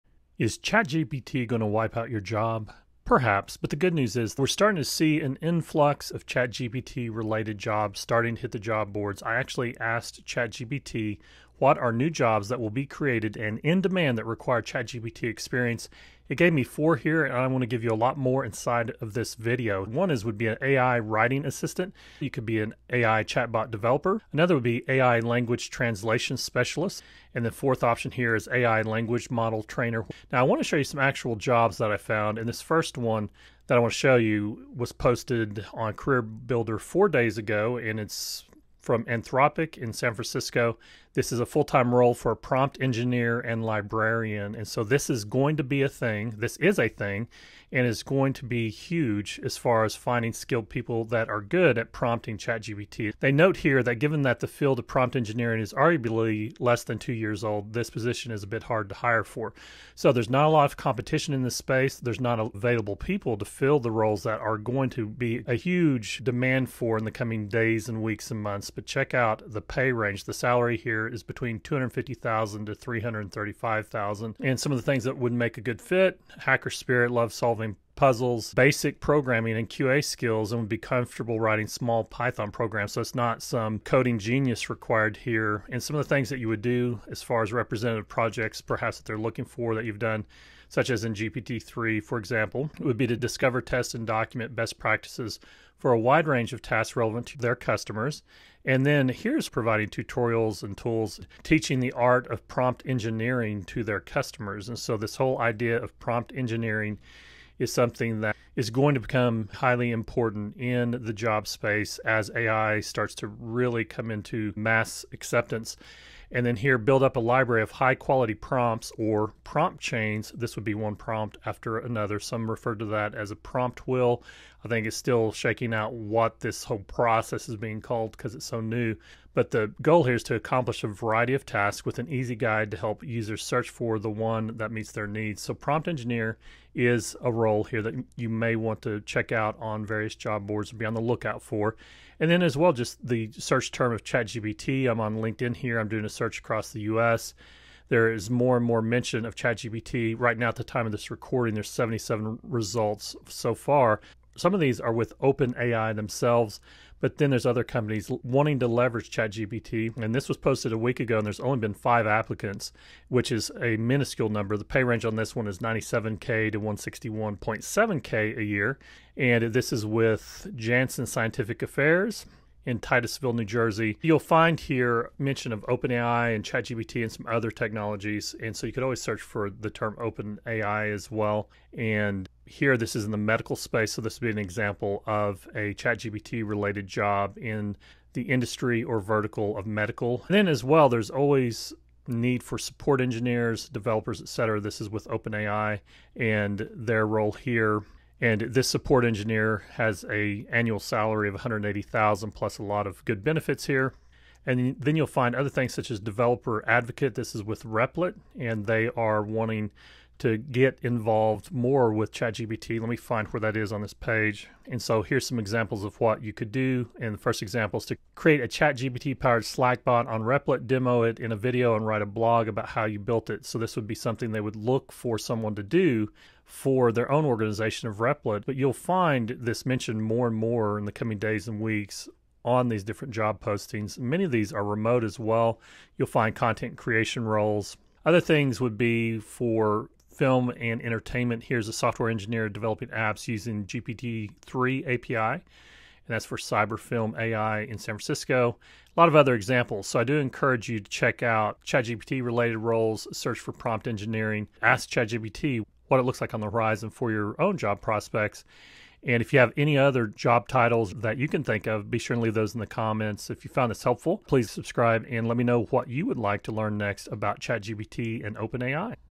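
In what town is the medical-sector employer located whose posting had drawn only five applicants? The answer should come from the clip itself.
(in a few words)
Titusville, New Jersey.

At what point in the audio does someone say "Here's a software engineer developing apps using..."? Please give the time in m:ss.
4:01.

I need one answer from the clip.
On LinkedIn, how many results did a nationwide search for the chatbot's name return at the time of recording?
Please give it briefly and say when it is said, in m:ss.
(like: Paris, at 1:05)
77, at 2:31.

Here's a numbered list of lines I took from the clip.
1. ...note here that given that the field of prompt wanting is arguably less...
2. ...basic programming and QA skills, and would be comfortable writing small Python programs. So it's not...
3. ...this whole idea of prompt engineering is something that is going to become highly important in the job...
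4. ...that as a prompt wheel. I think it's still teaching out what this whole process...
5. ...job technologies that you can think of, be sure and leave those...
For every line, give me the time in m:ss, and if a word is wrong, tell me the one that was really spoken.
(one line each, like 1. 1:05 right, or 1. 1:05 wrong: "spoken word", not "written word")
1. 0:53 wrong: "engineering", not "wanting"
2. 1:18 right
3. 1:44 right
4. 2:02 wrong: "shaking", not "teaching"
5. 4:20 wrong: "titles", not "technologies".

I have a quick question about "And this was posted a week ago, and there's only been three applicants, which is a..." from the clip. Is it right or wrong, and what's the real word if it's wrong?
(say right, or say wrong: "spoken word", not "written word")
wrong: "five", not "three".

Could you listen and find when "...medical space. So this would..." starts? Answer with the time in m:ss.
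3:03.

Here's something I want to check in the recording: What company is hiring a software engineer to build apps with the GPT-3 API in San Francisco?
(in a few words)
Cyberfilm AI.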